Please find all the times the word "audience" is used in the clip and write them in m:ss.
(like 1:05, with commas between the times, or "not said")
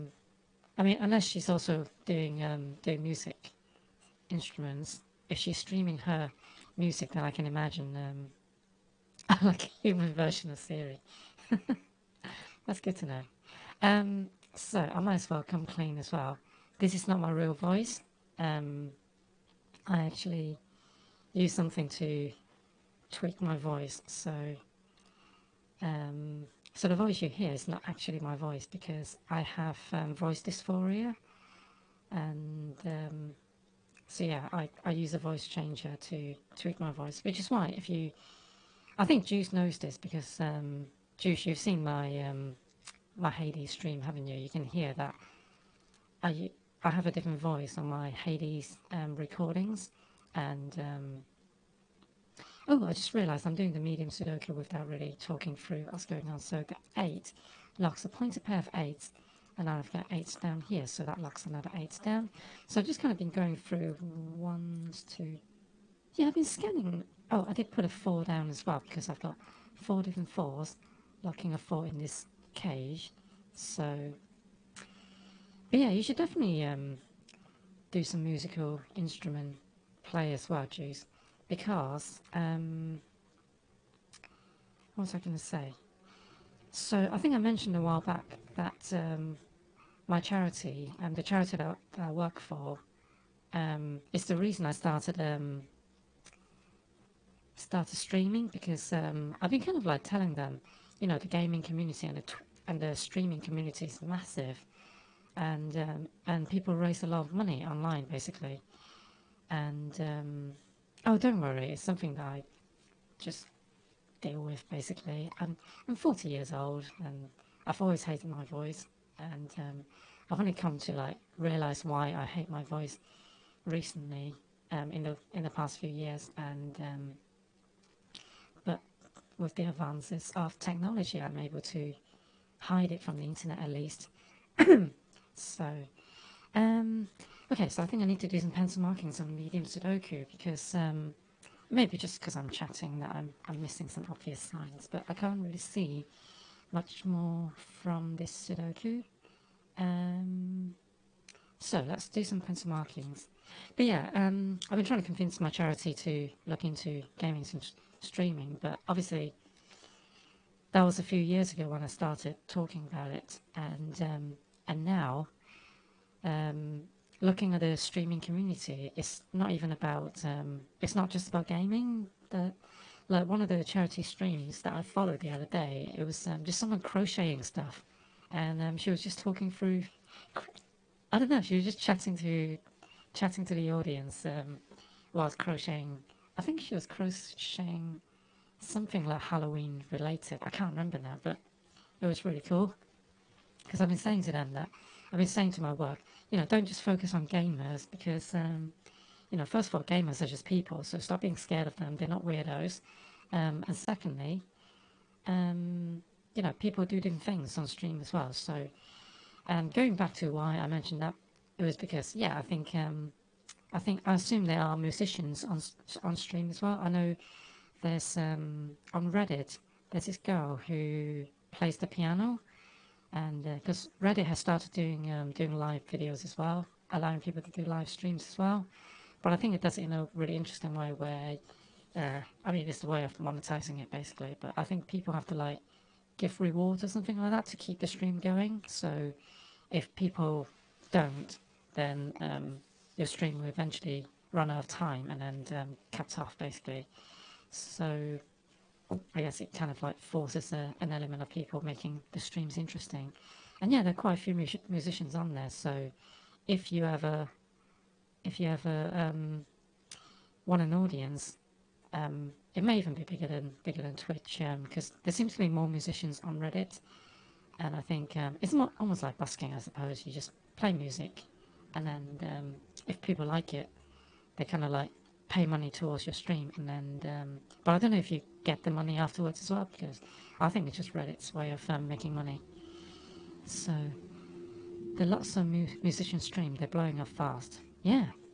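3:03, 4:20.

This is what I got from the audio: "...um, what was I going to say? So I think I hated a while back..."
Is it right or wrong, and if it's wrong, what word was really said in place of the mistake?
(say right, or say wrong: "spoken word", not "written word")
wrong: "mentioned", not "hated".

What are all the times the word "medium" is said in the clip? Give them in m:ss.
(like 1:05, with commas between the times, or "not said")
0:53, 2:19.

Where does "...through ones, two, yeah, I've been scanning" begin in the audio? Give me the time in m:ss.
1:03.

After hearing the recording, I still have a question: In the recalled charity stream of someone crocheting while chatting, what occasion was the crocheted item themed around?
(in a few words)
Halloween.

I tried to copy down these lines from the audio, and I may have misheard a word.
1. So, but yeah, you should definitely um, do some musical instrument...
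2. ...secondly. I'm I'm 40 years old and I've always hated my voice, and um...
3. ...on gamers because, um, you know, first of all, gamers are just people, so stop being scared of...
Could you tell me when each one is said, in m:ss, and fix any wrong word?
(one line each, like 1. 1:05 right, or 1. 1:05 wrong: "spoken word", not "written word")
1. 1:13 right
2. 1:54 wrong: "basically", not "secondly"
3. 3:17 right.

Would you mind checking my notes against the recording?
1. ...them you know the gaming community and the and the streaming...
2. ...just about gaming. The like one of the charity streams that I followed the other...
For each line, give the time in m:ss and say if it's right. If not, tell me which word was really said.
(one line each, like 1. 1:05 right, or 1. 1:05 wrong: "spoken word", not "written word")
1. 1:40 right
2. 2:51 right.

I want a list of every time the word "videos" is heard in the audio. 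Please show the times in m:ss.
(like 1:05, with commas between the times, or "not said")
3:45.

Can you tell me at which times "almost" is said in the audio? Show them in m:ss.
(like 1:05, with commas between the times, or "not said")
4:28.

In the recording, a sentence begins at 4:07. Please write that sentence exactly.
So I guess it kind of like forces a, an element of people making the streams interesting.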